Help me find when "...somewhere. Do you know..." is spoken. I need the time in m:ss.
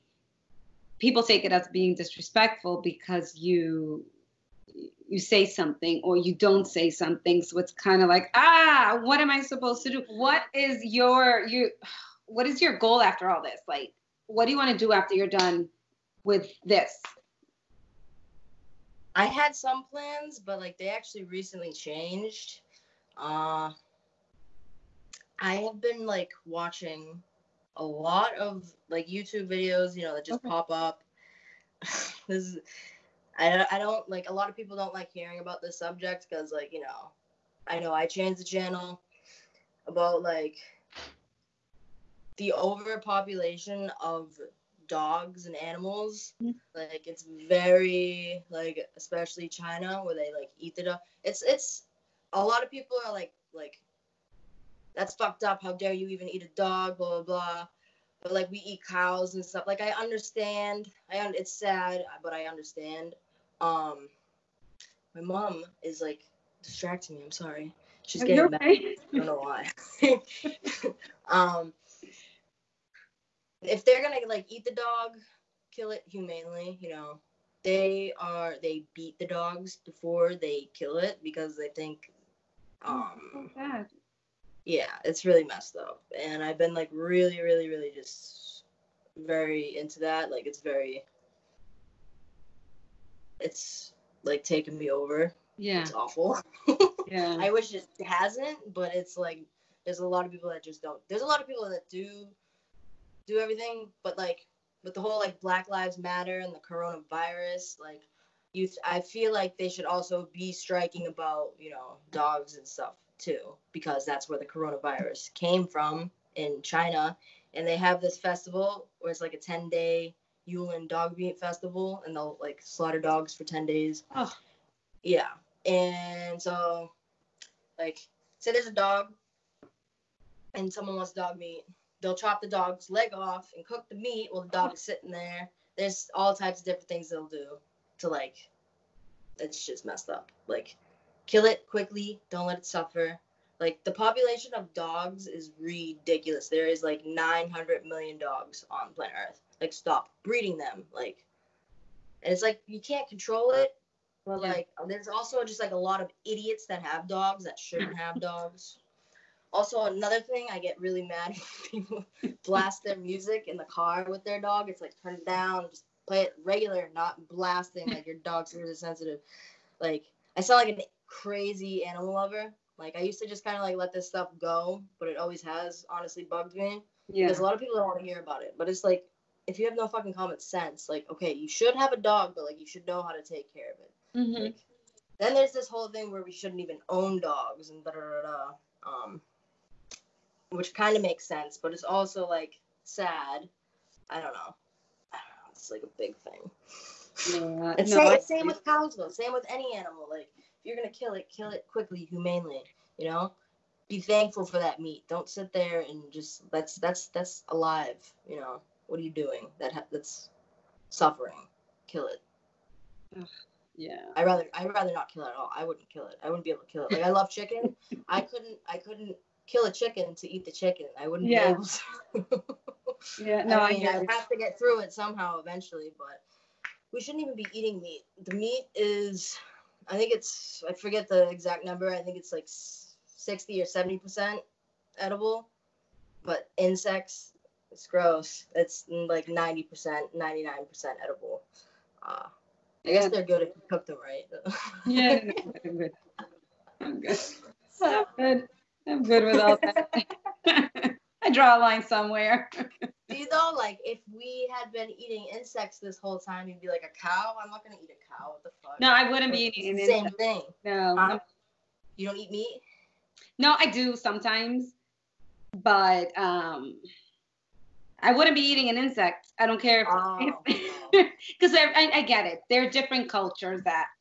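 4:11.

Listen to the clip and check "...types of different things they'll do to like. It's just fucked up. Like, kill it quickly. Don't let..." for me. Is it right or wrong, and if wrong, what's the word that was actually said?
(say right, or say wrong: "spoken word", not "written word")
wrong: "messed", not "fucked".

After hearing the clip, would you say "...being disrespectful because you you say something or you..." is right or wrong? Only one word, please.
right.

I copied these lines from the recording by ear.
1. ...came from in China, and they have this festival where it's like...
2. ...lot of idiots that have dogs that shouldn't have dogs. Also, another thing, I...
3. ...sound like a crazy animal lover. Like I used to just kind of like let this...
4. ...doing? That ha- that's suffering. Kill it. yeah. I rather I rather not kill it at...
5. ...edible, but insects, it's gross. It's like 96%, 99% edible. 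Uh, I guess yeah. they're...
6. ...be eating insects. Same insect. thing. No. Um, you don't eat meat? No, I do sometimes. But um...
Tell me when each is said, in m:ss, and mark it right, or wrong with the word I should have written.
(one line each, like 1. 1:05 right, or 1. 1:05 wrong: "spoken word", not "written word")
1. 1:55 right
2. 2:35 right
3. 2:50 right
4. 3:29 right
5. 3:54 wrong: "90", not "96"
6. 4:19 right.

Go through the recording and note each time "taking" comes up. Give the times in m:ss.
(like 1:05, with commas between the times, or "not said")
1:34.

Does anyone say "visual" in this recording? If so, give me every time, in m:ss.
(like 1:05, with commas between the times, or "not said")
not said.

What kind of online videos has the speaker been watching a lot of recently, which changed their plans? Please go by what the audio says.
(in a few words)
YouTube videos.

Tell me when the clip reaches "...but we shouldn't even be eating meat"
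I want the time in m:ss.
3:45.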